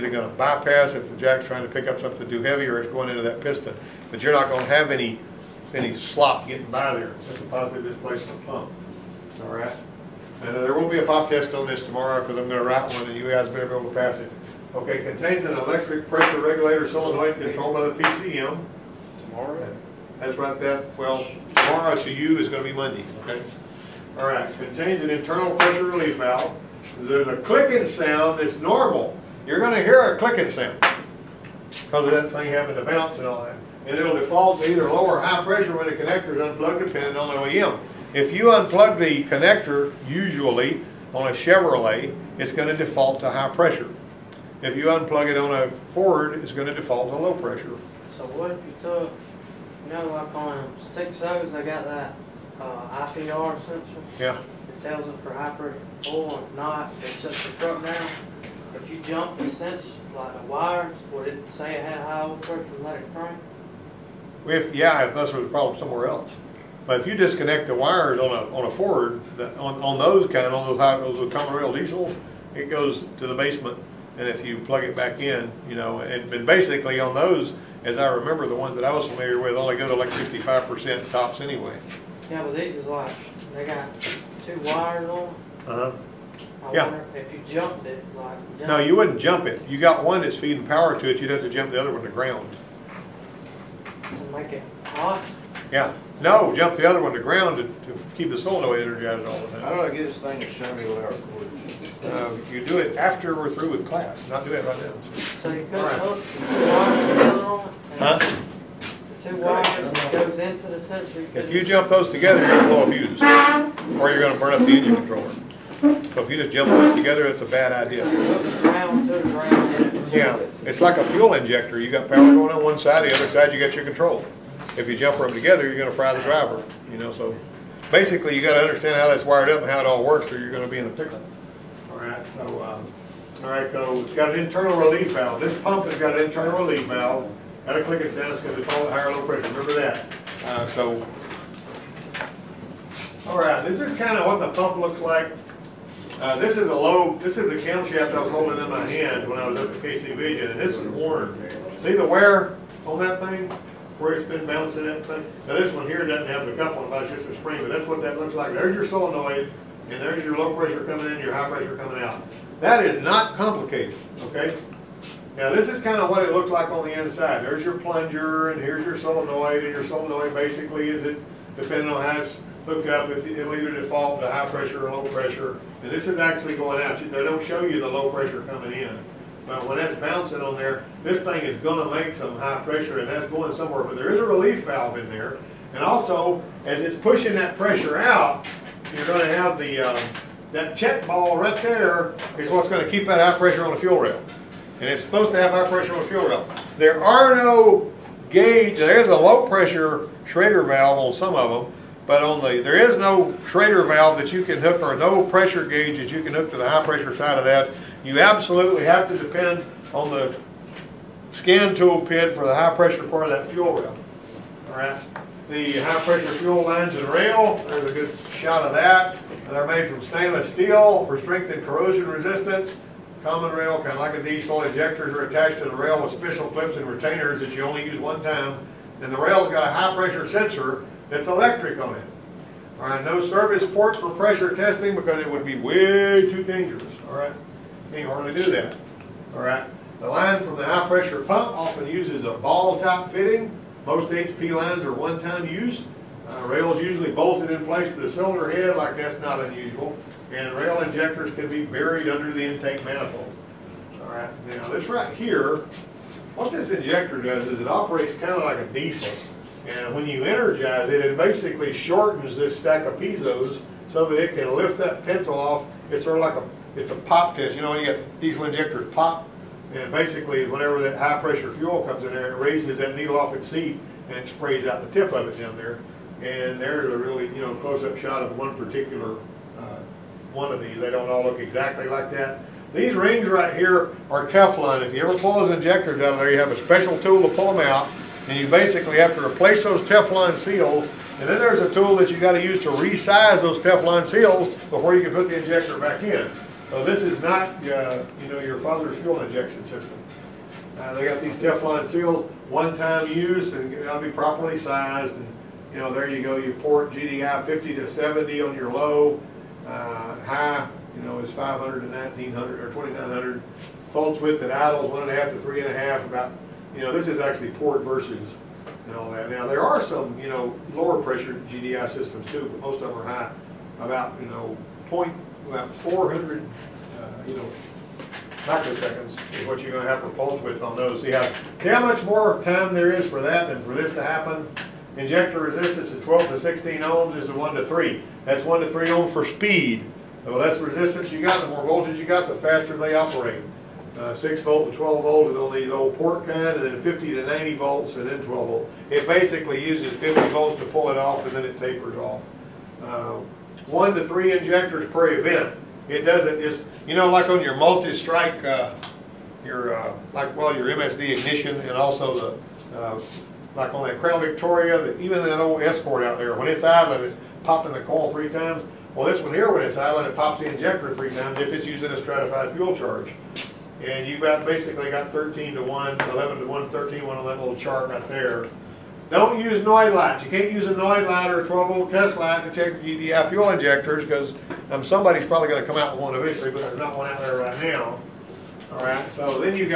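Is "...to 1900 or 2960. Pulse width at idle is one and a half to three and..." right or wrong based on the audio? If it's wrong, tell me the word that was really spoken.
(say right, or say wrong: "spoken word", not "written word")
wrong: "2900", not "2960".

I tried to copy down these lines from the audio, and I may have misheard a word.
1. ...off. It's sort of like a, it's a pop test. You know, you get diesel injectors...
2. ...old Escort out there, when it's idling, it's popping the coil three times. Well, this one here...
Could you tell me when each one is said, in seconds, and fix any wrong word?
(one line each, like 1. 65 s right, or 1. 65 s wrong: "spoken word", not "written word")
1. 265 s right
2. 365 s right.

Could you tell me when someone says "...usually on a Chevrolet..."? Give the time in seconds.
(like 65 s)
40 s.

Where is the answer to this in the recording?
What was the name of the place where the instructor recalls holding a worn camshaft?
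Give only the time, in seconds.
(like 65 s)
149 s.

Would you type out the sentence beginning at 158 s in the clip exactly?
There's your solenoid, and there's your low pressure coming in, your high pressure coming out.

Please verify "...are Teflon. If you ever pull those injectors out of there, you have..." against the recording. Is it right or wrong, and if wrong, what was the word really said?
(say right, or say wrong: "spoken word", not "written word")
right.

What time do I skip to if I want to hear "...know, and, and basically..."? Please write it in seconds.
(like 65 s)
75 s.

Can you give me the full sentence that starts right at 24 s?
All right, contains an internal pressure relief valve.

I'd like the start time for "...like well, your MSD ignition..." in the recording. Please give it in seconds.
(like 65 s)
360 s.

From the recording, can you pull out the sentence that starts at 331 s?
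See how, see how much more time there is for that than for this to happen?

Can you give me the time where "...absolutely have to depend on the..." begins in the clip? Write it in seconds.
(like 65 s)
208 s.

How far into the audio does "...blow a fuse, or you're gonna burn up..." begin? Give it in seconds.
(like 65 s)
112 s.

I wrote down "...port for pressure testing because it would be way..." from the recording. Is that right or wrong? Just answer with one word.
right.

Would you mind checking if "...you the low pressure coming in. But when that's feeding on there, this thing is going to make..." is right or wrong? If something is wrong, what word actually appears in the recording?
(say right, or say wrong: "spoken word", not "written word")
wrong: "bouncing", not "feeding".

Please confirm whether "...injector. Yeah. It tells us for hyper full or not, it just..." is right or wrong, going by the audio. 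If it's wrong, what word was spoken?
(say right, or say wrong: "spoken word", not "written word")
wrong: "sensor", not "injector".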